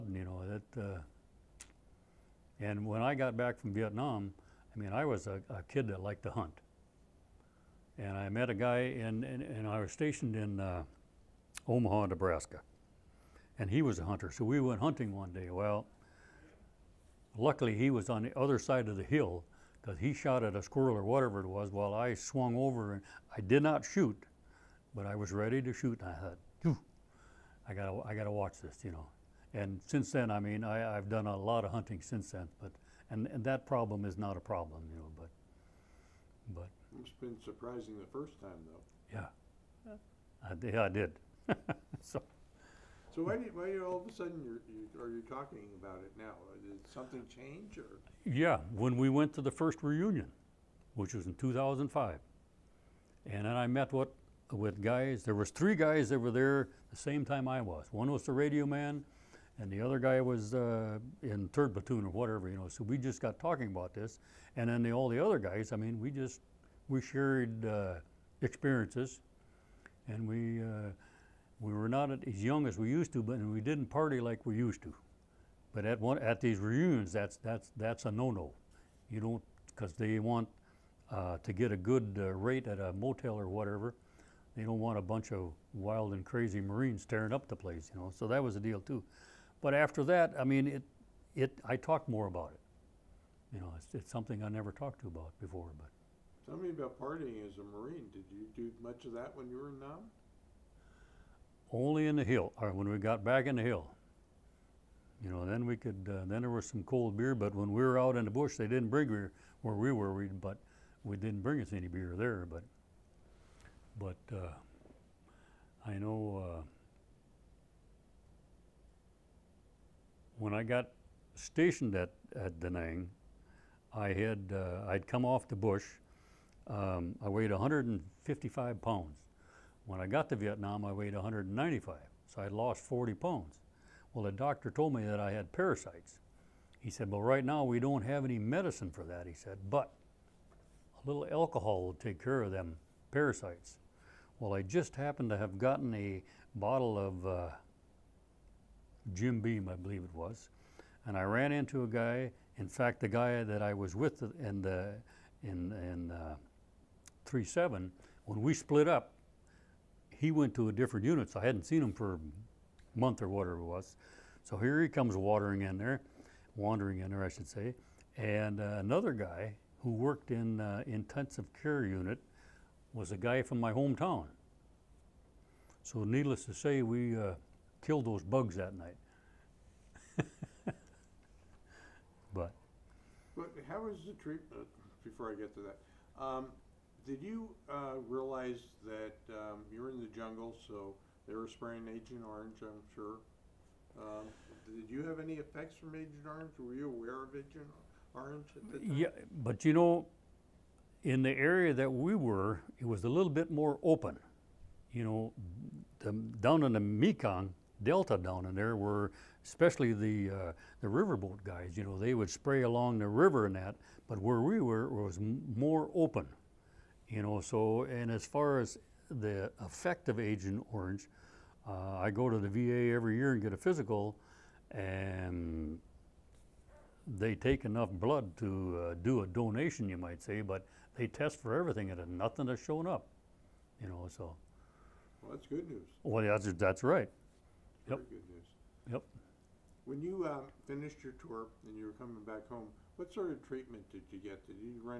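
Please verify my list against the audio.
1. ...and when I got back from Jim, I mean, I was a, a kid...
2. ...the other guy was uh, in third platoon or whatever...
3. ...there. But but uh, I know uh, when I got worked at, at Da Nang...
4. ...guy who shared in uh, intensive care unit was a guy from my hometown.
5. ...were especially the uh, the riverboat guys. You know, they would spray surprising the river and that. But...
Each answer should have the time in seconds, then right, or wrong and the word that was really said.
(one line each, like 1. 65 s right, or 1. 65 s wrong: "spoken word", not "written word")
1. 2 s wrong: "Vietnam", not "Jim"
2. 59 s right
3. 112 s wrong: "stationed", not "worked"
4. 169 s wrong: "worked", not "shared"
5. 208 s wrong: "along", not "surprising".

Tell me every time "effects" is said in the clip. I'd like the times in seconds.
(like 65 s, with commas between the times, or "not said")
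195 s, 219 s.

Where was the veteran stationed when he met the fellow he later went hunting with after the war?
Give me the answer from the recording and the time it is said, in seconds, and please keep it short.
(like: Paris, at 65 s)
Omaha, Nebraska, at 11 s.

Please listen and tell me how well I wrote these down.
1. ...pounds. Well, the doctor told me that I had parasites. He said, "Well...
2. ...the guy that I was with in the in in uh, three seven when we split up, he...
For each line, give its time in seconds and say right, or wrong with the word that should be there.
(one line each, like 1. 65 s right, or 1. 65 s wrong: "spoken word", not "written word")
1. 133 s right
2. 152 s right.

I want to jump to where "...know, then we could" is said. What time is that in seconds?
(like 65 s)
105 s.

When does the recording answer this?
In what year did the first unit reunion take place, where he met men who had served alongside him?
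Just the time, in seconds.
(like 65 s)
51 s.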